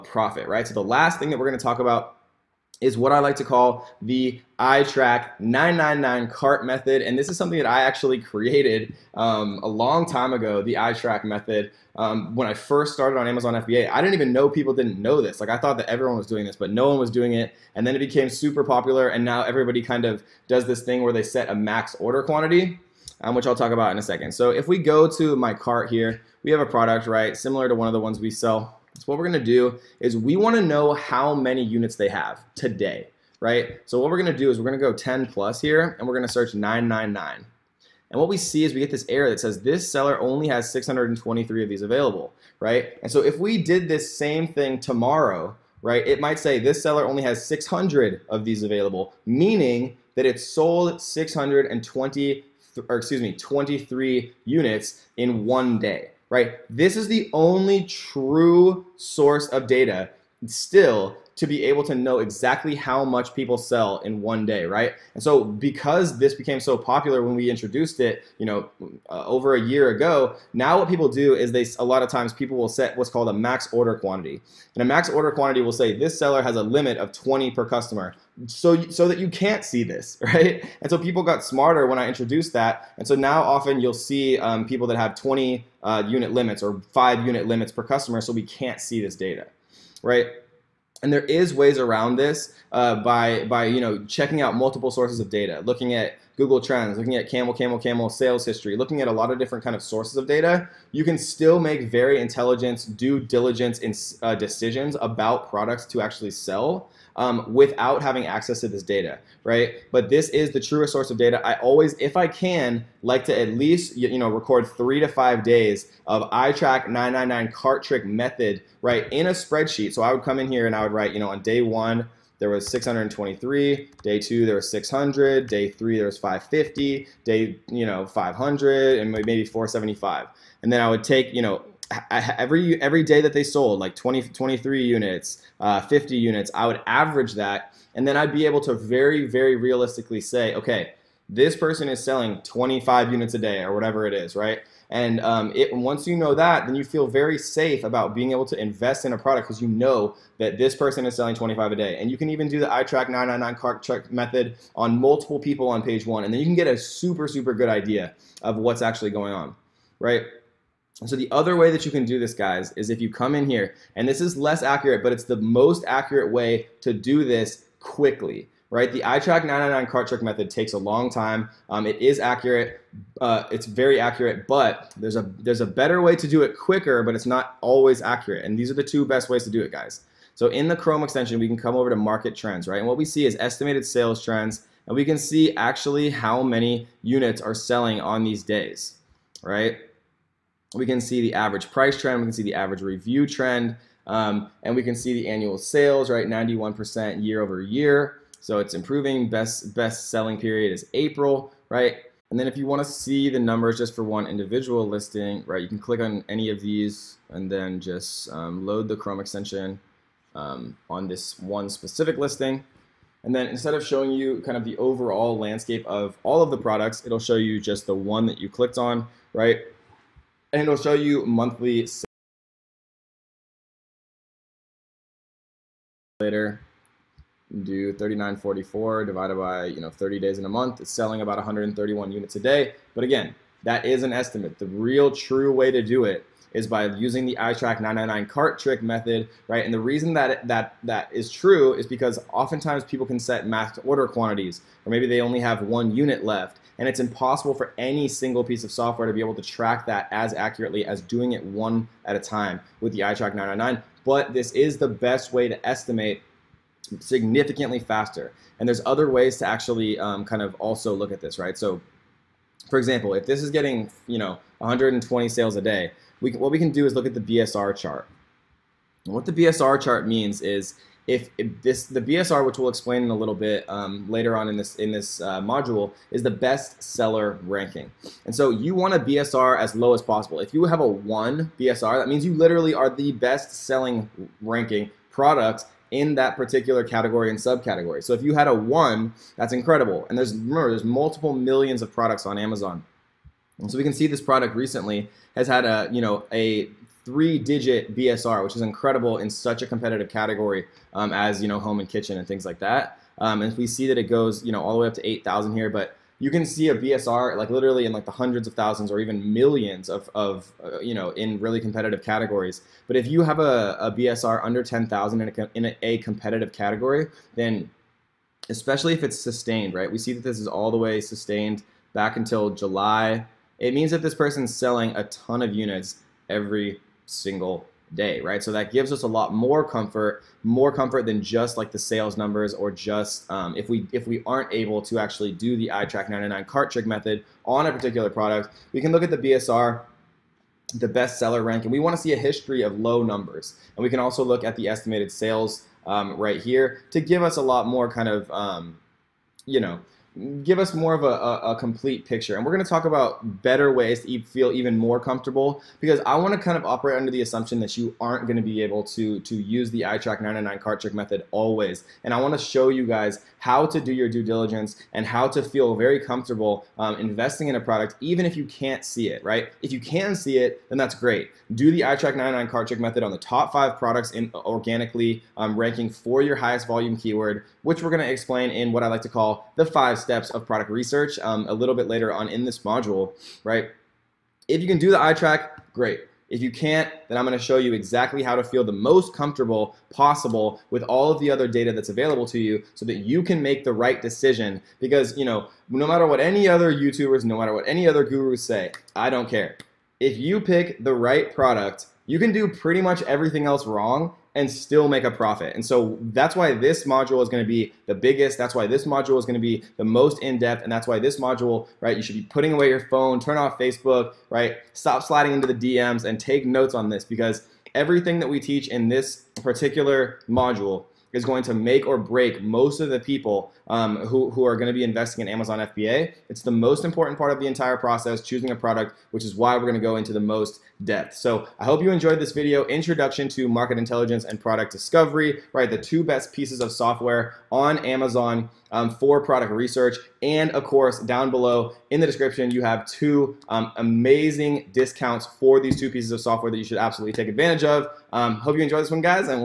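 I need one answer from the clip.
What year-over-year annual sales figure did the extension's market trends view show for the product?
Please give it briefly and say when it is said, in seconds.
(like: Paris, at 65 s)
91%, at 196 s.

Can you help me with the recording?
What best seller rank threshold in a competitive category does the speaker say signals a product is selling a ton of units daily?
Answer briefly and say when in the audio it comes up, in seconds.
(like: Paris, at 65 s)
10,000, at 314 s.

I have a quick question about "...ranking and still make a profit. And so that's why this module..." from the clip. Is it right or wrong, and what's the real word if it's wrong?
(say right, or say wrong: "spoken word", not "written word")
wrong: "wrong", not "ranking".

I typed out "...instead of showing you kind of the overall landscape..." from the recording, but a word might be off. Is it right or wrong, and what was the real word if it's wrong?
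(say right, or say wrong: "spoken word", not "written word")
right.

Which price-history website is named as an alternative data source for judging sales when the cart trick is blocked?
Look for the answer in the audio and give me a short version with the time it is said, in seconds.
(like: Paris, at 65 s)
CamelCamelCamel, at 97 s.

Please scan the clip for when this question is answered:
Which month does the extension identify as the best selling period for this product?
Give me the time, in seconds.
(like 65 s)
200 s.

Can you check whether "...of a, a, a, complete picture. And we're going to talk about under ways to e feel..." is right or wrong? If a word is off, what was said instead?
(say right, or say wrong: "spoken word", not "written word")
wrong: "better", not "under".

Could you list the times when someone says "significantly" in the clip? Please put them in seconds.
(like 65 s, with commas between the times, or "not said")
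256 s.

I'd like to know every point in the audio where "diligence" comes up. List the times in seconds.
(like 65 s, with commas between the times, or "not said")
103 s, 364 s.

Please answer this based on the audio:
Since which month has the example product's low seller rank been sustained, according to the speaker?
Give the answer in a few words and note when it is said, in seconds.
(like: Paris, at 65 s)
July, at 322 s.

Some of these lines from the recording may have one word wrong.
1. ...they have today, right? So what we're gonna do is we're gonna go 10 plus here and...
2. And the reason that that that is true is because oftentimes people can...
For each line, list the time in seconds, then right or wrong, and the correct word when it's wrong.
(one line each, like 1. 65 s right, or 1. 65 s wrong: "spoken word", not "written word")
1. 31 s right
2. 239 s right.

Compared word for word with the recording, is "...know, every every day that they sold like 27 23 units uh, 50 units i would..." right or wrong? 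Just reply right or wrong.
wrong.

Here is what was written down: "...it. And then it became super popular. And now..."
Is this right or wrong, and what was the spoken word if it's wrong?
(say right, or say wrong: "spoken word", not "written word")
right.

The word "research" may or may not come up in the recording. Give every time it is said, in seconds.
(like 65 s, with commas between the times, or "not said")
380 s, 439 s.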